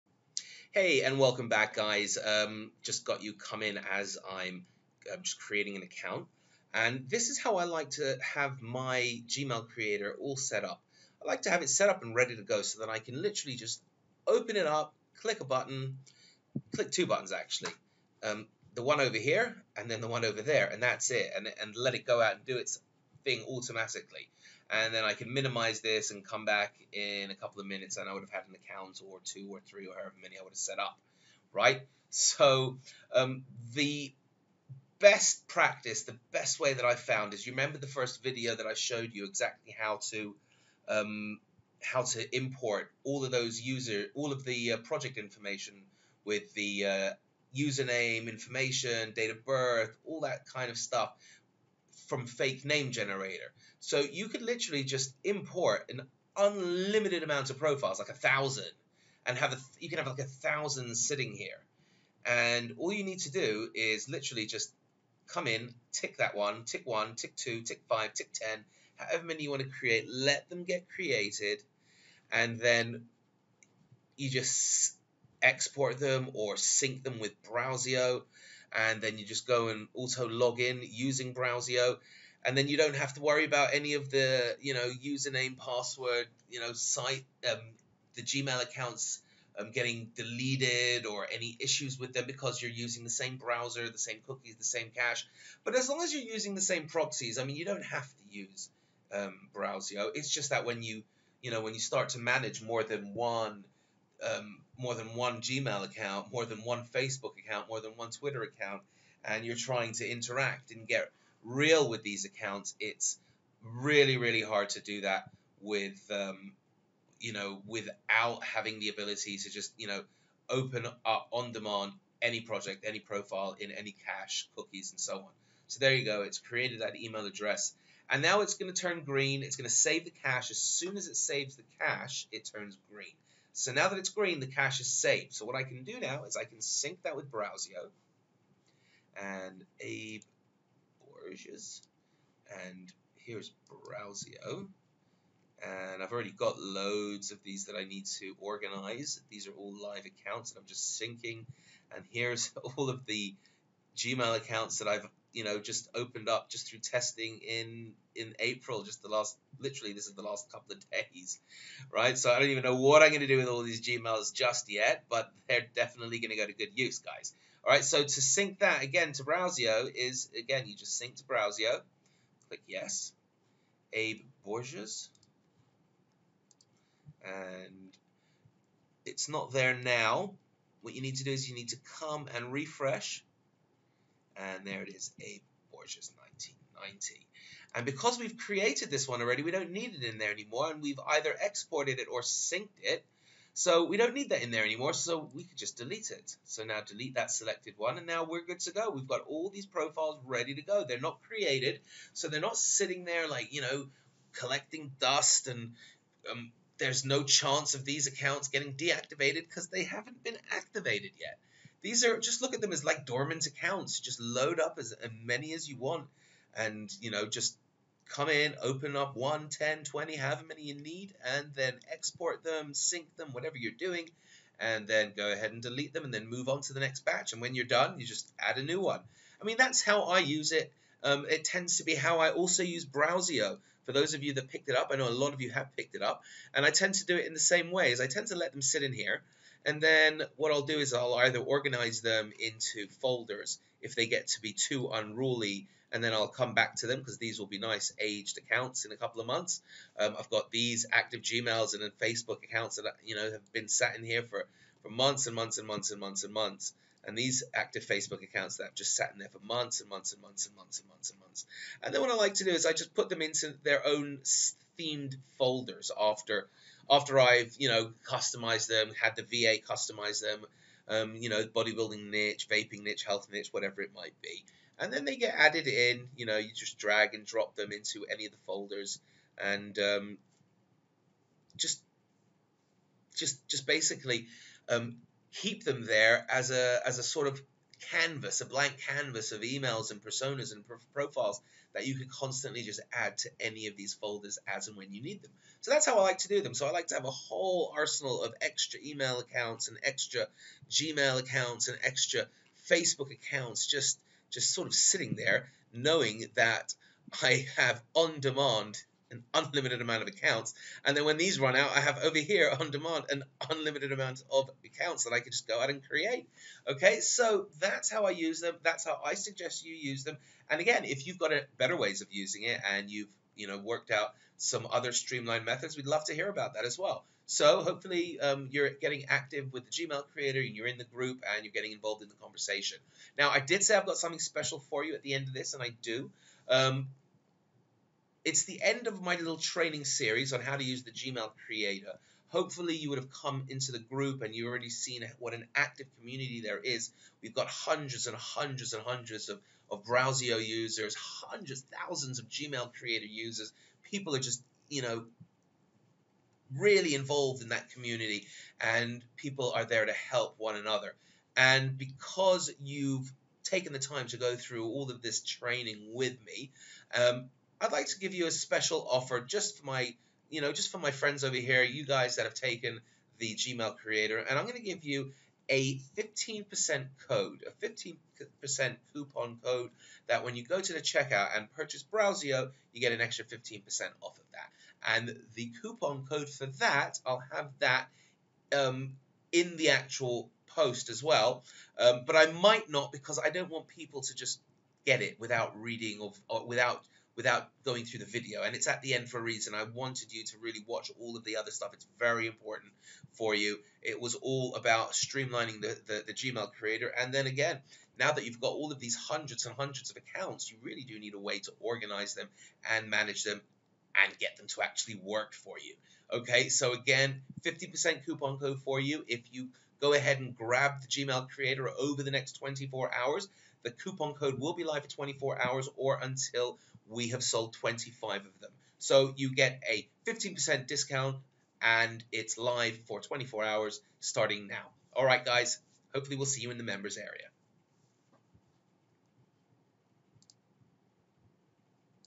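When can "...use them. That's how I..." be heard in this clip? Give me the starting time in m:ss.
5:18.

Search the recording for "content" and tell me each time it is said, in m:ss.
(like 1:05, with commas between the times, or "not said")
not said.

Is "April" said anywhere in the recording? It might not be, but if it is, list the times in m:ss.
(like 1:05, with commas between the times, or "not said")
2:38.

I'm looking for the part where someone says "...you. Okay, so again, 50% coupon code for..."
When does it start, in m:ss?
6:55.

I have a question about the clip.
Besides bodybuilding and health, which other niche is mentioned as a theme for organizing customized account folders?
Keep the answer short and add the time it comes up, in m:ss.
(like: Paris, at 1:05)
Vaping, at 4:32.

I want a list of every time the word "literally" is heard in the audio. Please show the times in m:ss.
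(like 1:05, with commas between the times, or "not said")
0:13, 0:54, 1:04, 2:39.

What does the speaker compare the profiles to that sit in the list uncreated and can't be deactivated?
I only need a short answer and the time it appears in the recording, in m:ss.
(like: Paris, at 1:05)
Dormant accounts, at 3:33.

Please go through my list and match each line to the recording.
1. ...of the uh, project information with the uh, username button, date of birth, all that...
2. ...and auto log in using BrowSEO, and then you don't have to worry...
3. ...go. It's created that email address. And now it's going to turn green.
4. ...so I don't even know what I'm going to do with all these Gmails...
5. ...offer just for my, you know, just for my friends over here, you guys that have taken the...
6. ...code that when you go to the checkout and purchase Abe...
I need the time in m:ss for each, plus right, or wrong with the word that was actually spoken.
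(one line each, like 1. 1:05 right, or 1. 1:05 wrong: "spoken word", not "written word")
1. 0:44 wrong: "information", not "button"
2. 1:19 right
3. 2:06 right
4. 2:42 right
5. 6:08 right
6. 6:19 wrong: "BrowSEO", not "Abe".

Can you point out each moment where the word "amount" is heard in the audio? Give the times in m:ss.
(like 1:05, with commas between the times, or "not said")
0:57, 5:09, 5:13.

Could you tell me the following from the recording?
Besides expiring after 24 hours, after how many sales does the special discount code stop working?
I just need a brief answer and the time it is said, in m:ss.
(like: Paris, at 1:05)
25, at 7:07.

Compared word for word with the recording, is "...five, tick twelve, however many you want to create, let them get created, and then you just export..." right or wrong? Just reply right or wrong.
wrong.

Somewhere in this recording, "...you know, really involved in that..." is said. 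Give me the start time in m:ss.
5:54.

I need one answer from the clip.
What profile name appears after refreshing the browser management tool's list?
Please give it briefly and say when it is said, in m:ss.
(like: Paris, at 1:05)
A Borges 1990, at 3:05.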